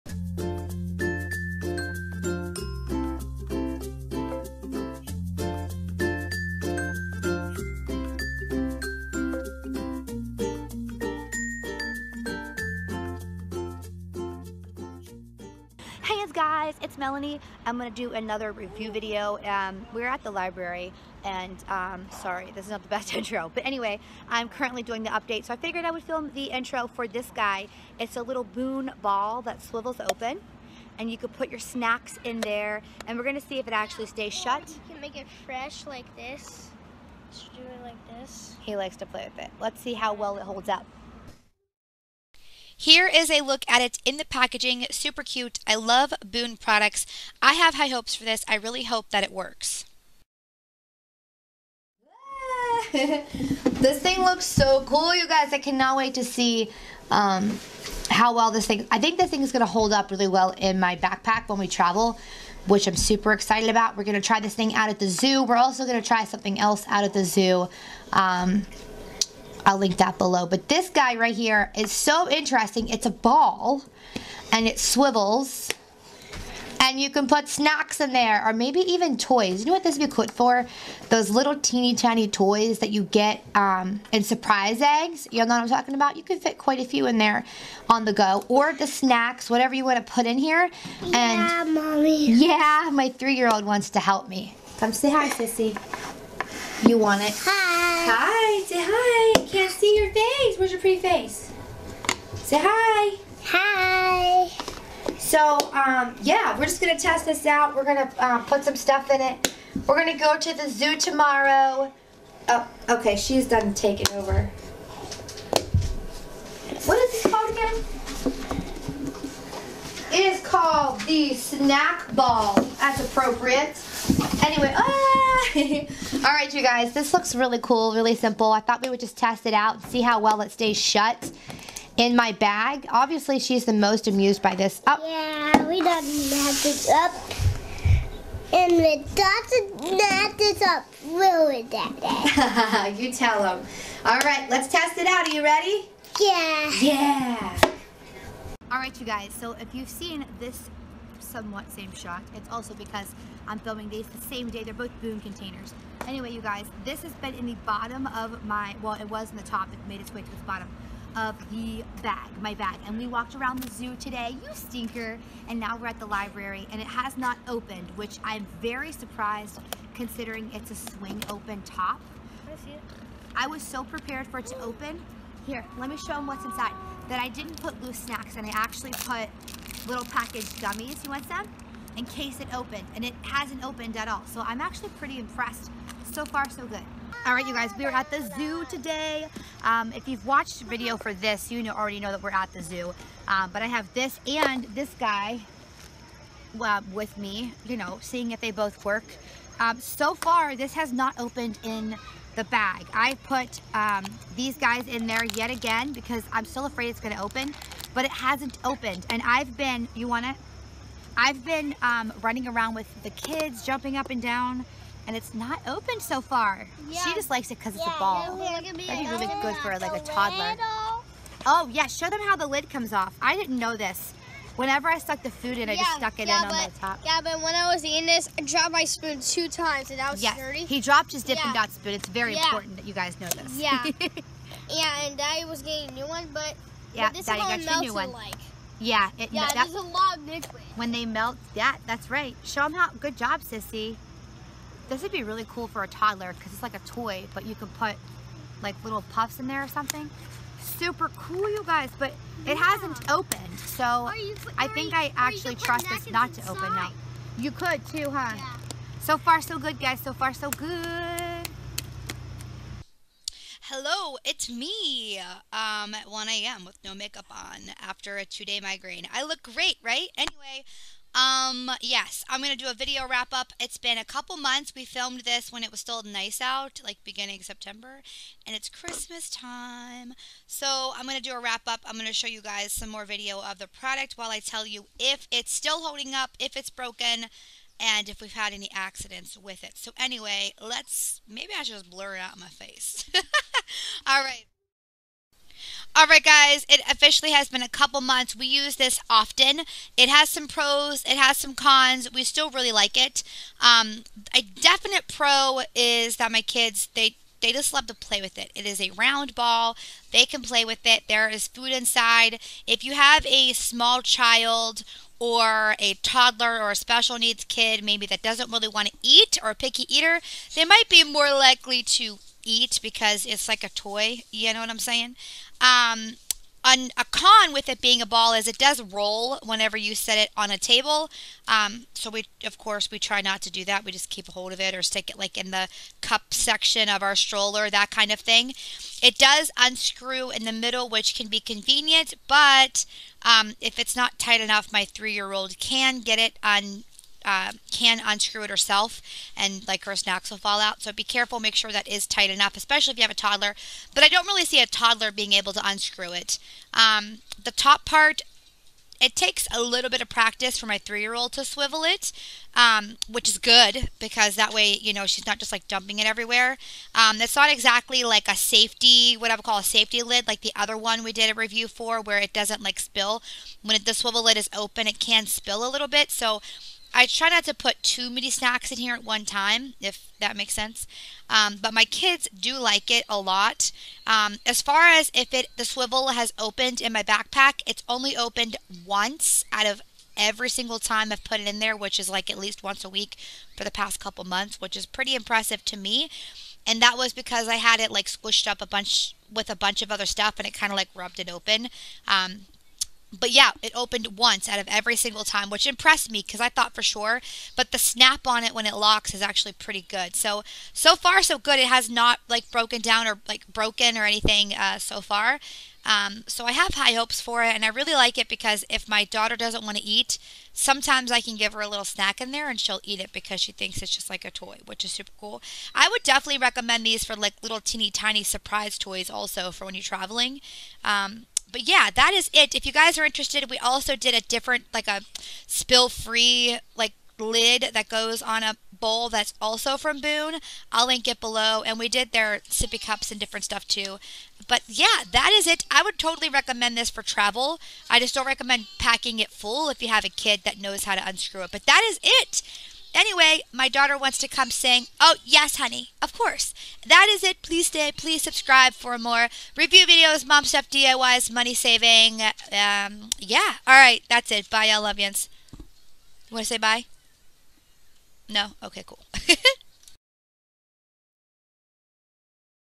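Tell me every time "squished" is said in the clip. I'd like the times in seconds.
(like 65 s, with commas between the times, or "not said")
398 s.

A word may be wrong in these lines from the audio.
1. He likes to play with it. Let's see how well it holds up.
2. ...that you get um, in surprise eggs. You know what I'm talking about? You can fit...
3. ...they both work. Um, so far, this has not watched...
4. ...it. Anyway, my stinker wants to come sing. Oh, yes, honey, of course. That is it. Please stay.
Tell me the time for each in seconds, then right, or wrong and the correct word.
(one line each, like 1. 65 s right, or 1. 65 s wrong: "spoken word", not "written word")
1. 38 s right
2. 82 s right
3. 198 s wrong: "opened", not "watched"
4. 452 s wrong: "daughter", not "stinker".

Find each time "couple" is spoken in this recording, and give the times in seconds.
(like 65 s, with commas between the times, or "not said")
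274 s, 297 s, 394 s.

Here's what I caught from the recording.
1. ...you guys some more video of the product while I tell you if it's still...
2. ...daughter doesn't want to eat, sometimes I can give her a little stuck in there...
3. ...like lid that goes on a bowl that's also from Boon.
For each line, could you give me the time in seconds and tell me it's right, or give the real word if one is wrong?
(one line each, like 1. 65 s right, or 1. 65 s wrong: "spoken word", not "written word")
1. 282 s right
2. 419 s wrong: "snack", not "stuck"
3. 436 s right.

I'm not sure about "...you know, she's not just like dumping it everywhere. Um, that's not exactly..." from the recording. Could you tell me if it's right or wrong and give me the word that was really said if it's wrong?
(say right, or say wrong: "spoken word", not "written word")
right.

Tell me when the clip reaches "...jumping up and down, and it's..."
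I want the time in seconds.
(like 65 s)
213 s.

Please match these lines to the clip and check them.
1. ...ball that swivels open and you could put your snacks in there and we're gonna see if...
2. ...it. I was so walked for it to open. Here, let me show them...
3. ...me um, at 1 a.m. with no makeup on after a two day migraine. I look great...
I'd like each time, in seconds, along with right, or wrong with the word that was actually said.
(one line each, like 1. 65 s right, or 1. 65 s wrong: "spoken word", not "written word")
1. 29 s right
2. 172 s wrong: "prepared", not "walked"
3. 264 s right.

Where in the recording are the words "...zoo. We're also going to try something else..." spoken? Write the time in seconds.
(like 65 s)
65 s.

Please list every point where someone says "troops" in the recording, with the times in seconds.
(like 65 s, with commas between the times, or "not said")
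not said.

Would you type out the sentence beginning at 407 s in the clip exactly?
But the snap on it when it locks is actually pretty good.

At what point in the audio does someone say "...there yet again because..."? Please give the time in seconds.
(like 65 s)
205 s.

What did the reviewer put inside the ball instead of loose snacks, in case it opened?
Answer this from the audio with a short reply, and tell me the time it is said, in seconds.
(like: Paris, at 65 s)
packaged gummies, at 180 s.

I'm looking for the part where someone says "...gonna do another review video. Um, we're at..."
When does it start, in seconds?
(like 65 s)
17 s.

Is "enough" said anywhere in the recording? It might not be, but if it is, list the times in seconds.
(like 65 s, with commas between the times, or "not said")
344 s, 352 s.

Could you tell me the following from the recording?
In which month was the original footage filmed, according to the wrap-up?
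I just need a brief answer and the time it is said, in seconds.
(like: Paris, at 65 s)
September, at 277 s.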